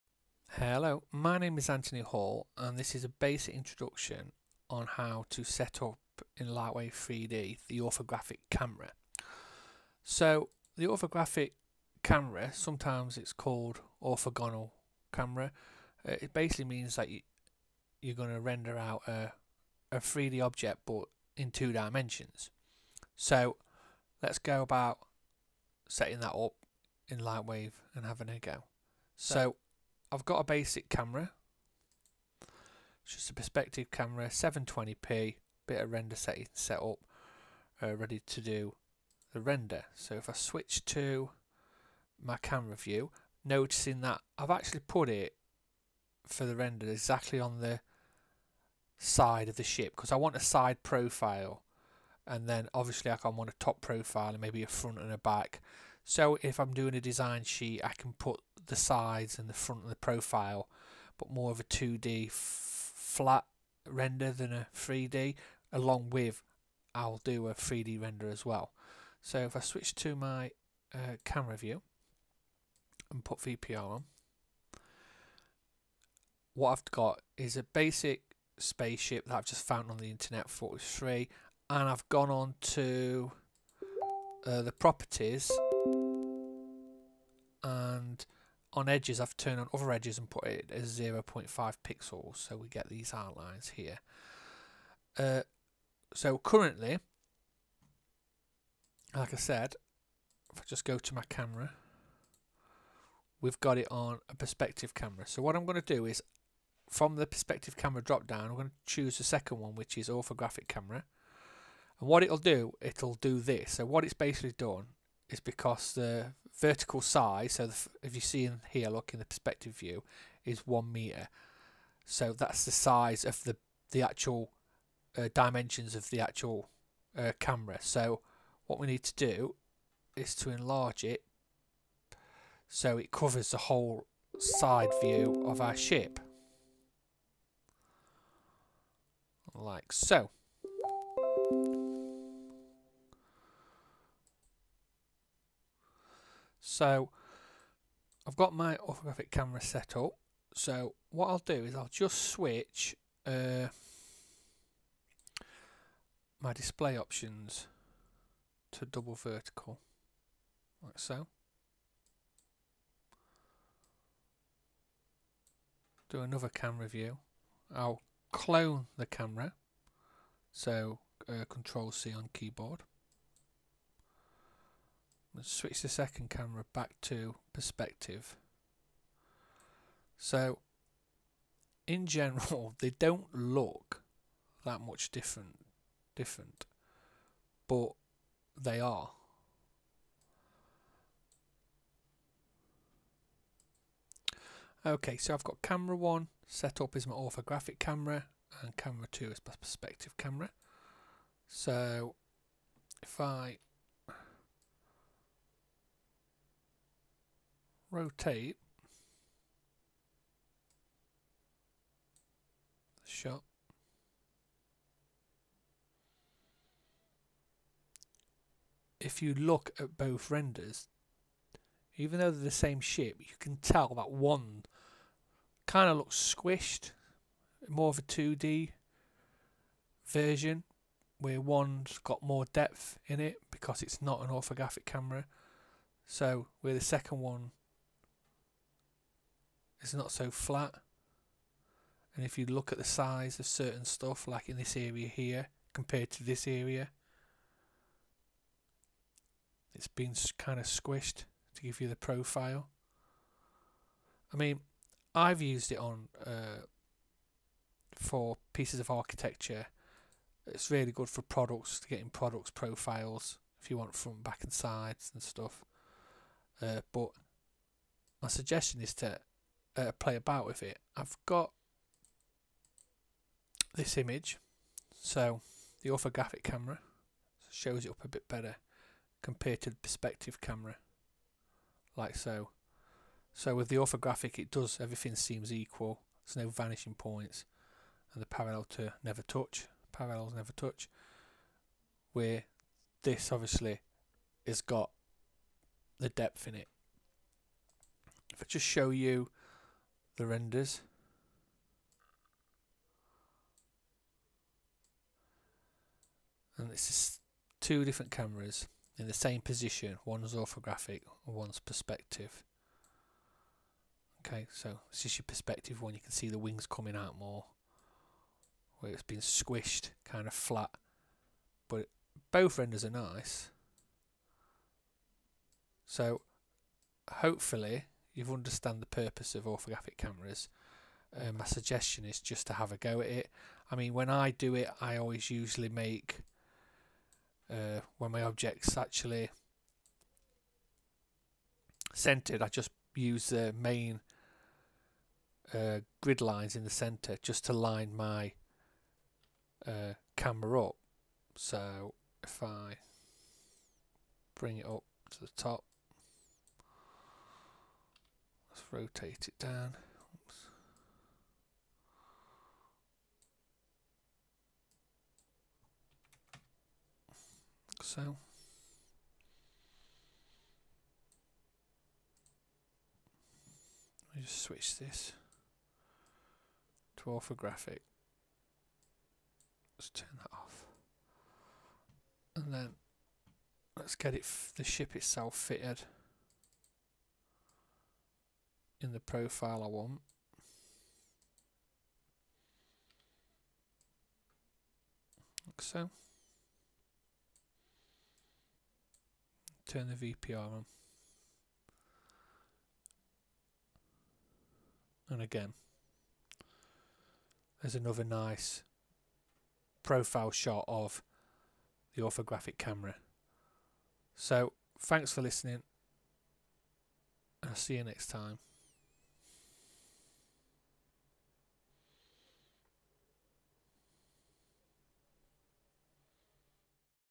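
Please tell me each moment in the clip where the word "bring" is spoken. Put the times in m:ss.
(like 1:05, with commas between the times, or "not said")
5:54.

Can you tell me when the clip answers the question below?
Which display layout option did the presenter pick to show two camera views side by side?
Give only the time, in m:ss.
2:38.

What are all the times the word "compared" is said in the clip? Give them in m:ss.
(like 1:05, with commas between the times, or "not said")
4:05, 4:39.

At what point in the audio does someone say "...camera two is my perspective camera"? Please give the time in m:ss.
3:18.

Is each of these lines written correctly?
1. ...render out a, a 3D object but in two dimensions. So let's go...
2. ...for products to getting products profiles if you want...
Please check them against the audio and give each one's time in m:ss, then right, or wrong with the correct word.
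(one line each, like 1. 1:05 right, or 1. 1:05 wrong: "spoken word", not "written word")
1. 0:18 right
2. 4:21 right.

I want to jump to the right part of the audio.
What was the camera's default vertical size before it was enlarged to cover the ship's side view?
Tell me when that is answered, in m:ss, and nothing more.
2:00.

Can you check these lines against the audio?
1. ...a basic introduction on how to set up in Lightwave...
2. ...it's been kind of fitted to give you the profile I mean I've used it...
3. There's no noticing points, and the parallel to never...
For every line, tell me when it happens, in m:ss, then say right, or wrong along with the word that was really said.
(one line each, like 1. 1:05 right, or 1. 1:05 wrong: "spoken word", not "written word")
1. 0:03 right
2. 4:09 wrong: "squished", not "fitted"
3. 4:46 wrong: "vanishing", not "noticing".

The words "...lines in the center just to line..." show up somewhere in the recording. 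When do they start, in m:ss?
5:46.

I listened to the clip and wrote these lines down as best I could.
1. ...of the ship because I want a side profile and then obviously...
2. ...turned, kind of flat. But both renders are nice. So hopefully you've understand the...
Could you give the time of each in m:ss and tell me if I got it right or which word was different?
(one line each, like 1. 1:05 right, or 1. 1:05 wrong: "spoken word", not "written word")
1. 0:49 right
2. 5:19 wrong: "squished", not "turned".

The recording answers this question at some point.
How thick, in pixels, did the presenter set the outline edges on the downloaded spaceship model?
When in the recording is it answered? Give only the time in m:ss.
1:30.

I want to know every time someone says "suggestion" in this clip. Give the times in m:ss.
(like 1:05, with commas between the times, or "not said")
4:28, 5:31.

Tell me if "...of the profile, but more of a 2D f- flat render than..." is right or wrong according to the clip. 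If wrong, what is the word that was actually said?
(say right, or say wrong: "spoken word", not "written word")
right.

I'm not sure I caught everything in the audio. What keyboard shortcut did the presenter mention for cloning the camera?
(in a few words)
Control C.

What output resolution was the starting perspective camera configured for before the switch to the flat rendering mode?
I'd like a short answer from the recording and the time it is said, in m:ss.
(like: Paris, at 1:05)
720p, at 0:34.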